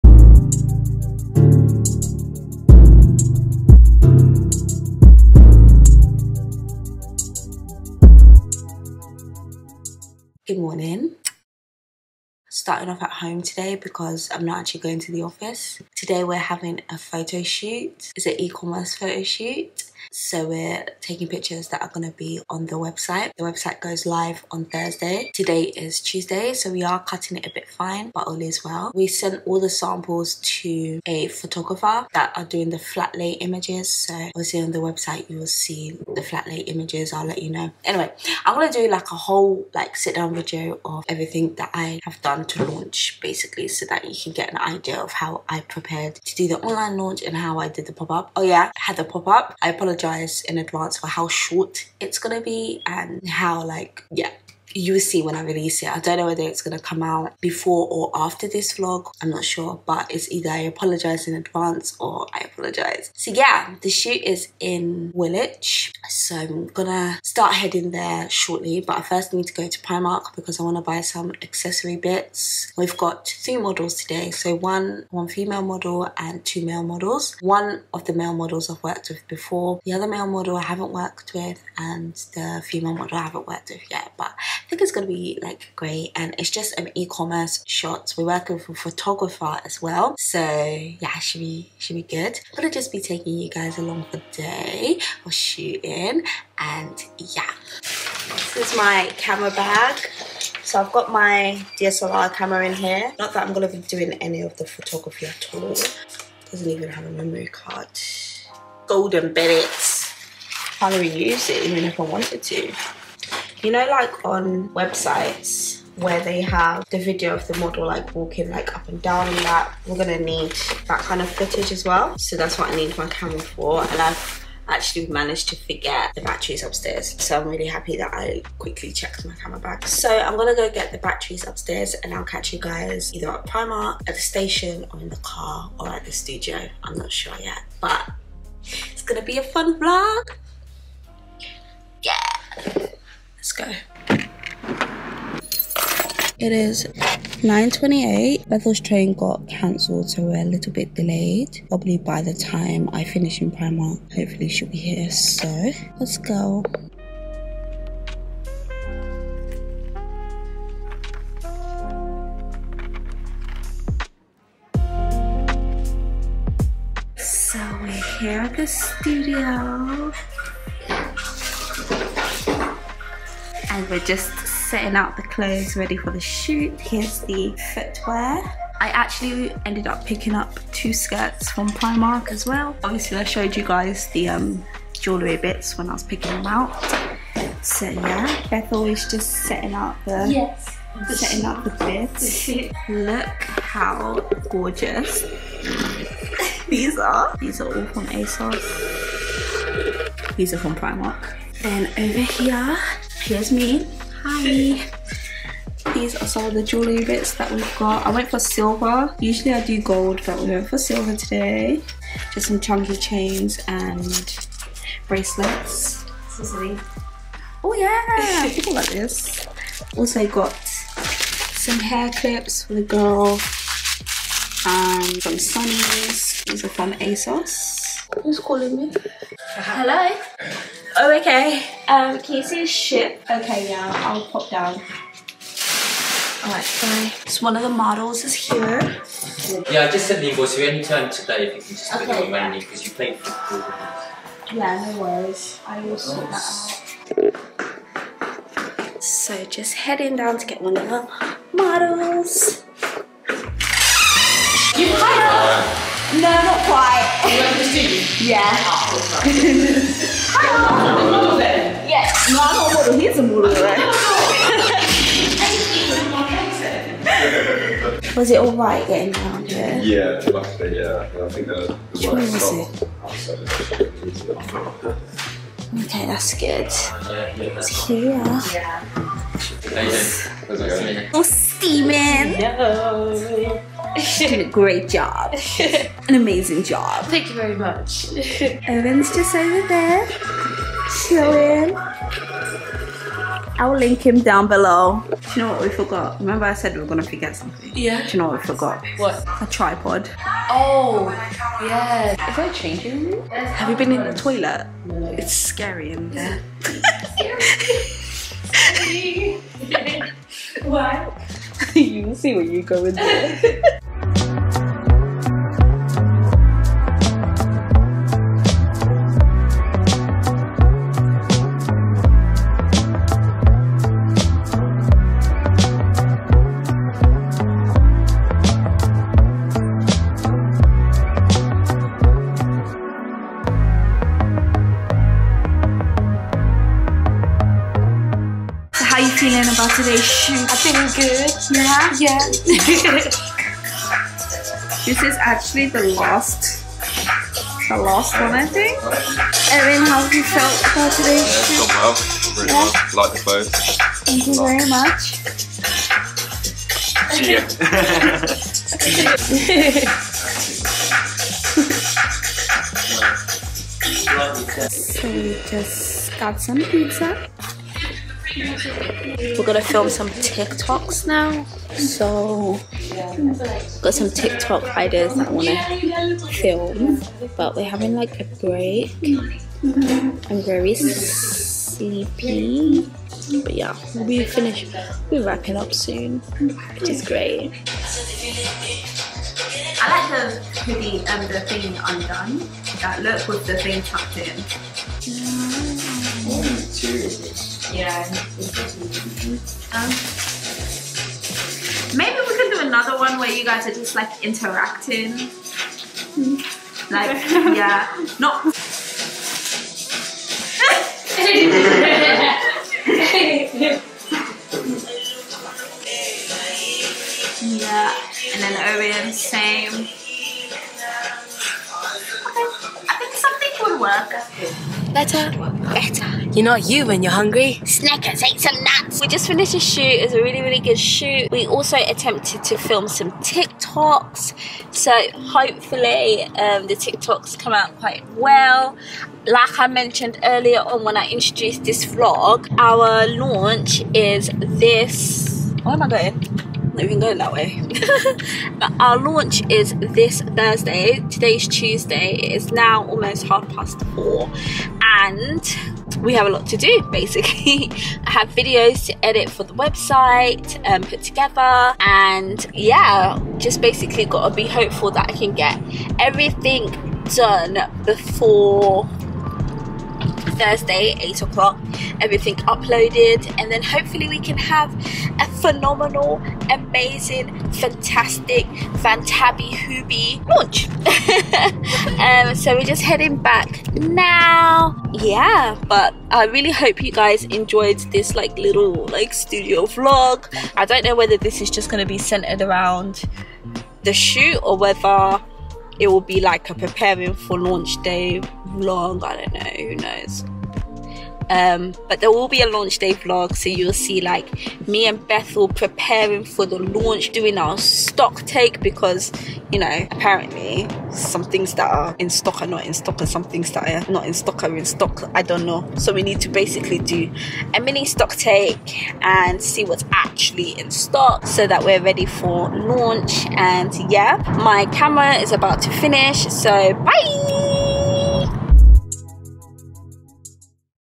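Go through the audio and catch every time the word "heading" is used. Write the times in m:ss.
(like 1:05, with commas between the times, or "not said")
1:07, 4:09, 8:02.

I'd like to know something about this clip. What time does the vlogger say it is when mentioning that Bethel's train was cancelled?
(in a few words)
9:28.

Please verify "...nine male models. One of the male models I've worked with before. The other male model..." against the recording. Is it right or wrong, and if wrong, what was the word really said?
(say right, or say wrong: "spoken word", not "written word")
wrong: "two", not "nine".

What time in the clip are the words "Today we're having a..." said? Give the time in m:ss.
0:15.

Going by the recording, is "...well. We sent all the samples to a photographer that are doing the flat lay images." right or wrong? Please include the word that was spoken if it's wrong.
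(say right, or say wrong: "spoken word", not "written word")
right.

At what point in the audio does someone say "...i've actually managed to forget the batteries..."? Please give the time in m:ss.
2:04.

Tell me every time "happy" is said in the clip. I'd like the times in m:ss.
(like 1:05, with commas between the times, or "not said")
2:07.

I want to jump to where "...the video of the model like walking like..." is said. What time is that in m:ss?
1:56.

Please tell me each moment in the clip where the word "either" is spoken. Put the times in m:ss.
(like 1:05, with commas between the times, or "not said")
1:00, 2:13.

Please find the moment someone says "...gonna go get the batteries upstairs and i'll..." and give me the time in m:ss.
2:10.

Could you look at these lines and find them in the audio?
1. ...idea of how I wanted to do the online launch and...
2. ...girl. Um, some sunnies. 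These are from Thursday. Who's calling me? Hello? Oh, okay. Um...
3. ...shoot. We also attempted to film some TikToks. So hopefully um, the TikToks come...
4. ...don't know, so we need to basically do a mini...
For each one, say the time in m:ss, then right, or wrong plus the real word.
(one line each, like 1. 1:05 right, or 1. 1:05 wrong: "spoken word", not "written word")
1. 0:44 wrong: "prepared", not "wanted"
2. 3:42 wrong: "ASOS", not "Thursday"
3. 7:10 right
4. 8:35 right.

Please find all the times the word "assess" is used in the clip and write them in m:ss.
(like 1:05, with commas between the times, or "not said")
not said.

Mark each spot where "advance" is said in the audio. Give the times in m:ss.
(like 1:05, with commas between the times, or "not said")
0:50, 1:01.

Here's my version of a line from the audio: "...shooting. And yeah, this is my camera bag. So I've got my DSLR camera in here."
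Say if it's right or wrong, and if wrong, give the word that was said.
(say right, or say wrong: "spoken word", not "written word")
right.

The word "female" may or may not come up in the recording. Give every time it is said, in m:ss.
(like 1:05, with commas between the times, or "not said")
1:15, 1:22.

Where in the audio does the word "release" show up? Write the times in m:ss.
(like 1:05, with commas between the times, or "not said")
0:55.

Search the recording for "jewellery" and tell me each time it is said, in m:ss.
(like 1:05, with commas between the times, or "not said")
3:04, 3:26.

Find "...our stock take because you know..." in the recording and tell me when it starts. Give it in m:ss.
8:27.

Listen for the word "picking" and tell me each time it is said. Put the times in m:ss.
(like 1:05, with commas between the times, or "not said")
3:00, 3:06.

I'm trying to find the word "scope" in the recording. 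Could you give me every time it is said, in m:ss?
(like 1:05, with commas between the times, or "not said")
not said.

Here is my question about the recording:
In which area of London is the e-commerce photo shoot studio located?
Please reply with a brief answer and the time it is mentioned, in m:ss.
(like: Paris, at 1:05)
Woolwich, at 1:05.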